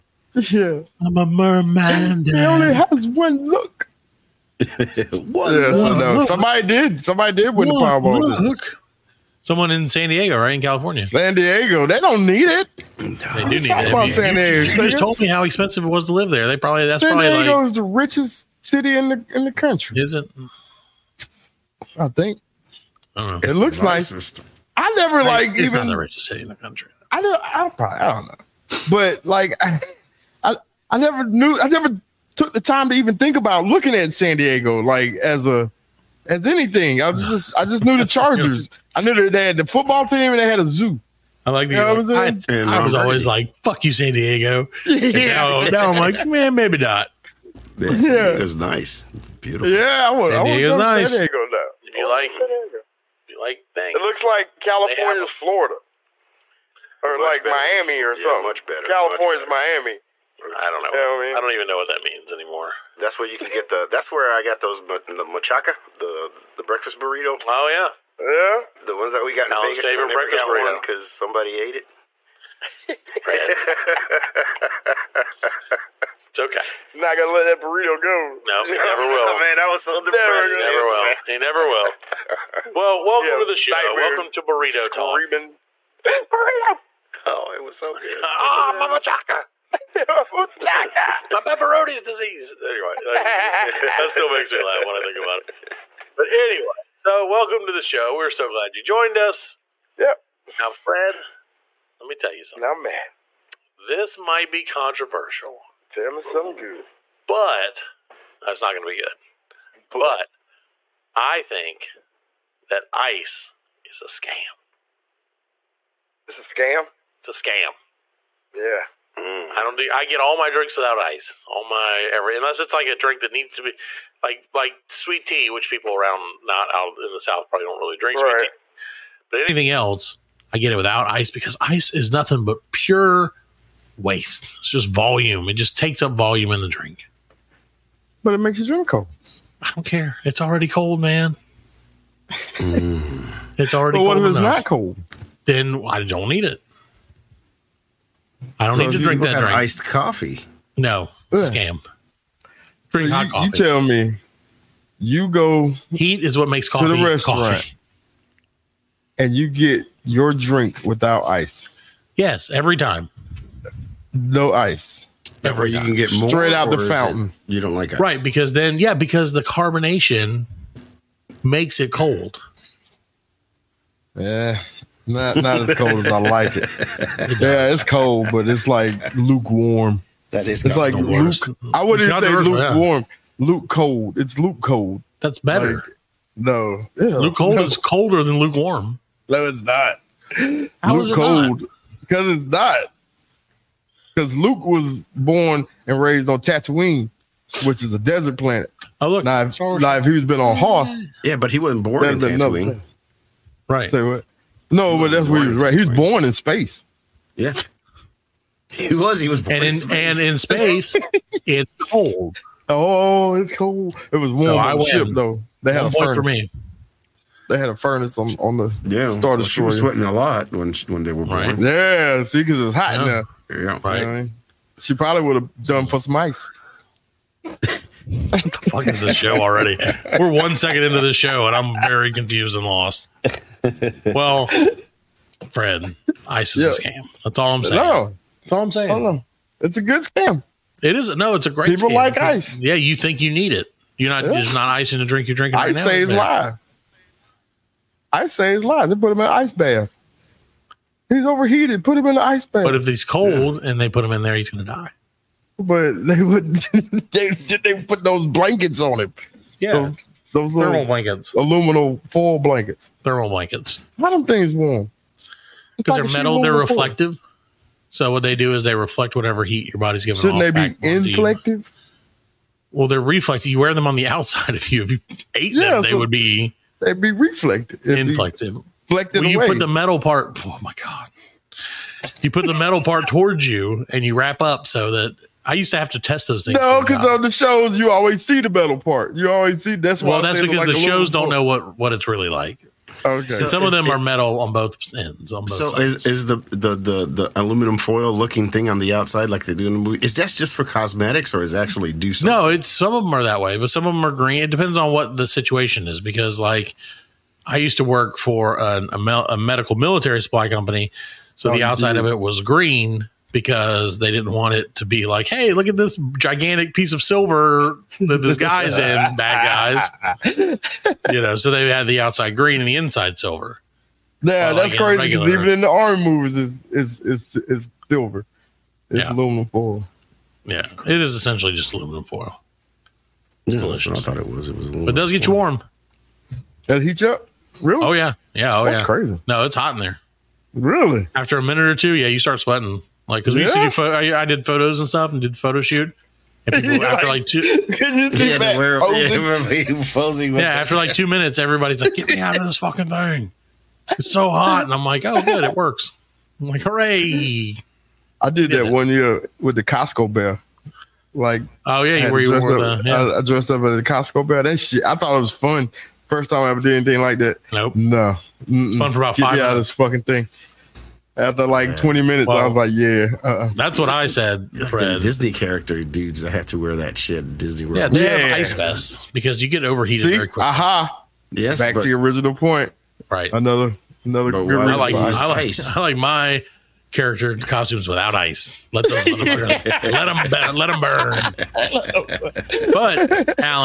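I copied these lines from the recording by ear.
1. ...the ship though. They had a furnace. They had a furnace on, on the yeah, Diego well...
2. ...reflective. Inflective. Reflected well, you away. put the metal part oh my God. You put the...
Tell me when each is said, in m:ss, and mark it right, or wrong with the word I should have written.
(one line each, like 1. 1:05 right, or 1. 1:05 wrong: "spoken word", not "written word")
1. 3:34 wrong: "Star", not "Diego"
2. 4:37 right.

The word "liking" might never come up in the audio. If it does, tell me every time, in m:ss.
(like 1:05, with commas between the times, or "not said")
not said.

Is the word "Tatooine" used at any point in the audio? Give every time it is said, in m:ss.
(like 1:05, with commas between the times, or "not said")
3:16, 3:22.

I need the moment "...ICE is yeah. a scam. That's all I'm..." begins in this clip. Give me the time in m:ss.
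3:56.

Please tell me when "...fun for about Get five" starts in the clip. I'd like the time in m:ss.
6:08.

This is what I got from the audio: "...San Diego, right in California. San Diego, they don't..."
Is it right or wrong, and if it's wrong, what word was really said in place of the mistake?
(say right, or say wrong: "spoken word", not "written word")
right.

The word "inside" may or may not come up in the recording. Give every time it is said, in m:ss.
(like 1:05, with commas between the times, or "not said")
5:22.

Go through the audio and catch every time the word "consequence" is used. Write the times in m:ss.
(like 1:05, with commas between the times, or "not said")
not said.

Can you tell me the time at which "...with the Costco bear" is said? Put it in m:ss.
5:59.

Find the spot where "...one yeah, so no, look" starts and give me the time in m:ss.
0:04.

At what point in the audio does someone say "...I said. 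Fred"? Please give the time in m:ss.
6:13.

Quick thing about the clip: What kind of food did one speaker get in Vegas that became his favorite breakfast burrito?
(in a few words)
machaca.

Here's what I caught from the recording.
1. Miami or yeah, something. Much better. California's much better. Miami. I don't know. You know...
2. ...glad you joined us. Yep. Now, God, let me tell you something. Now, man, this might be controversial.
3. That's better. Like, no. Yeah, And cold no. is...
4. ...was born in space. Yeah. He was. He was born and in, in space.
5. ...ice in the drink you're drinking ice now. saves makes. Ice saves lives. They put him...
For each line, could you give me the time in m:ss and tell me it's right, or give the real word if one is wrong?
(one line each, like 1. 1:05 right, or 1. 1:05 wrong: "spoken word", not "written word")
1. 0:57 right
2. 1:38 wrong: "Fred", not "God"
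3. 3:05 wrong: "Luke", not "And"
4. 3:25 right
5. 4:04 wrong: "lives", not "makes".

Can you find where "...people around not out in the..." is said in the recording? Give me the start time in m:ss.
2:05.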